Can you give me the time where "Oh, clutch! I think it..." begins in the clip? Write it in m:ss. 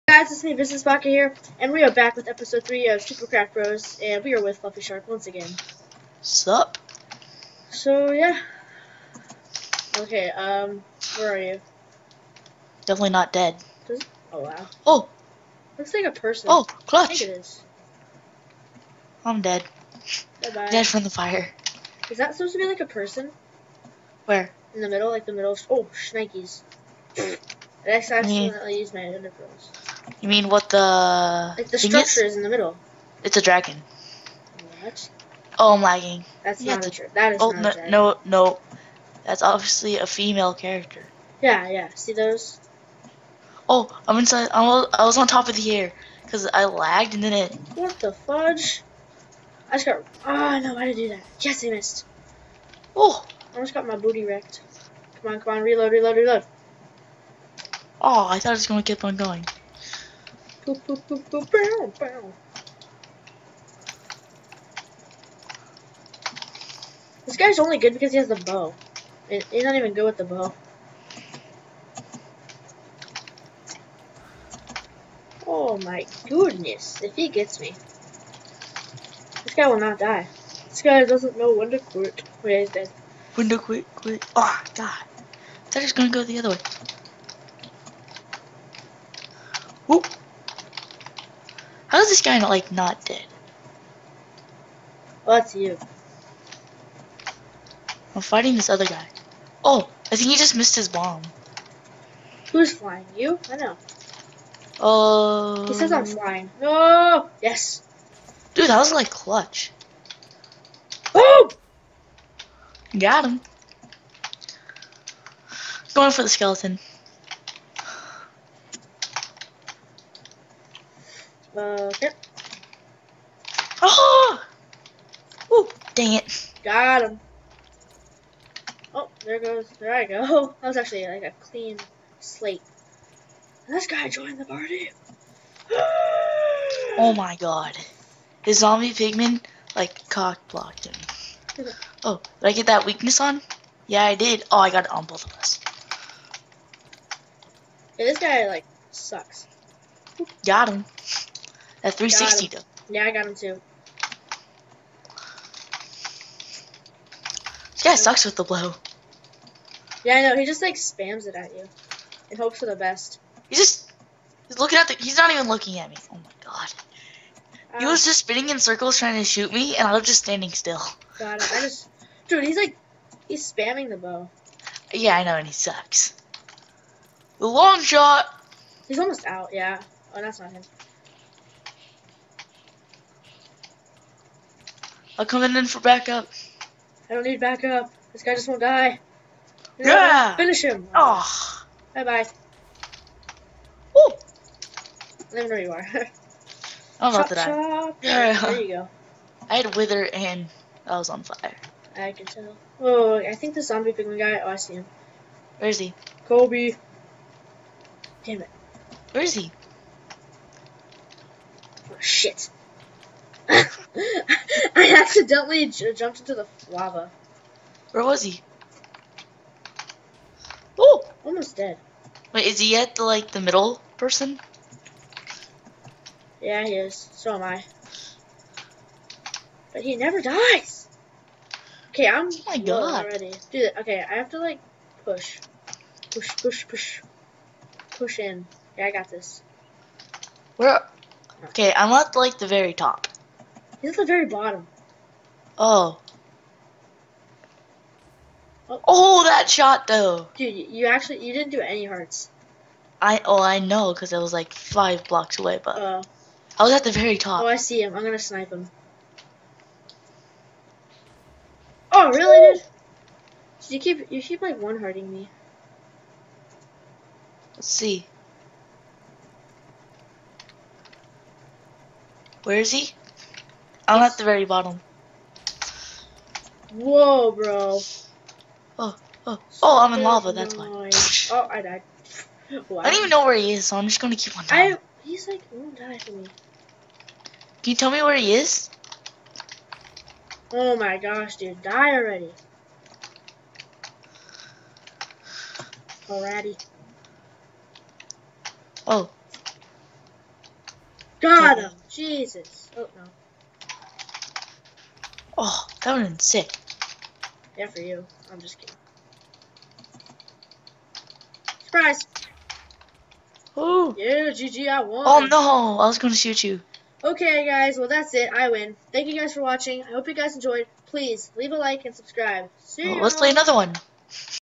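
0:16.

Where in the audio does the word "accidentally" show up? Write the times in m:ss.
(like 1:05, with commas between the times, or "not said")
0:28, 3:35.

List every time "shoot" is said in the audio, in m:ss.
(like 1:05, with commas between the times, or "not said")
2:49, 5:16.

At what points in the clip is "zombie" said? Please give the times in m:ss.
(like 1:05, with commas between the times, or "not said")
2:18, 3:23.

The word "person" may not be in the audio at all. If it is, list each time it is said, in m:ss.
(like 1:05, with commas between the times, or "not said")
0:16, 0:22, 3:43.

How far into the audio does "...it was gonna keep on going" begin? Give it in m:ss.
0:58.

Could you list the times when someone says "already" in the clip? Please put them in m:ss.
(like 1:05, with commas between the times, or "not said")
3:53, 4:51.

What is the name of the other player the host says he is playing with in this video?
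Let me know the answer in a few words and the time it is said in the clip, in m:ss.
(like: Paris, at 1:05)
Fluffy Shark, at 0:04.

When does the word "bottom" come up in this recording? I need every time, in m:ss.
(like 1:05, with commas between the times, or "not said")
4:04, 4:34.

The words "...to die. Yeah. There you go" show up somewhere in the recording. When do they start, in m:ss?
3:17.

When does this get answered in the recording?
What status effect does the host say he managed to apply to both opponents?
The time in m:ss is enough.
2:22.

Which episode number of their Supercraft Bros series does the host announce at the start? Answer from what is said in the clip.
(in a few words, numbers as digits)
3.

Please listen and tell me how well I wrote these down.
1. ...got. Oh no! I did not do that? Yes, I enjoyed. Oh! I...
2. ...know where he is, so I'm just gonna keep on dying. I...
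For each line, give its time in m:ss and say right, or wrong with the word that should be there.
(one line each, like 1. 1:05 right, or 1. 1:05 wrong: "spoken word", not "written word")
1. 0:49 wrong: "missed", not "enjoyed"
2. 4:43 right.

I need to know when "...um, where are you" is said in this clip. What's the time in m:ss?
0:10.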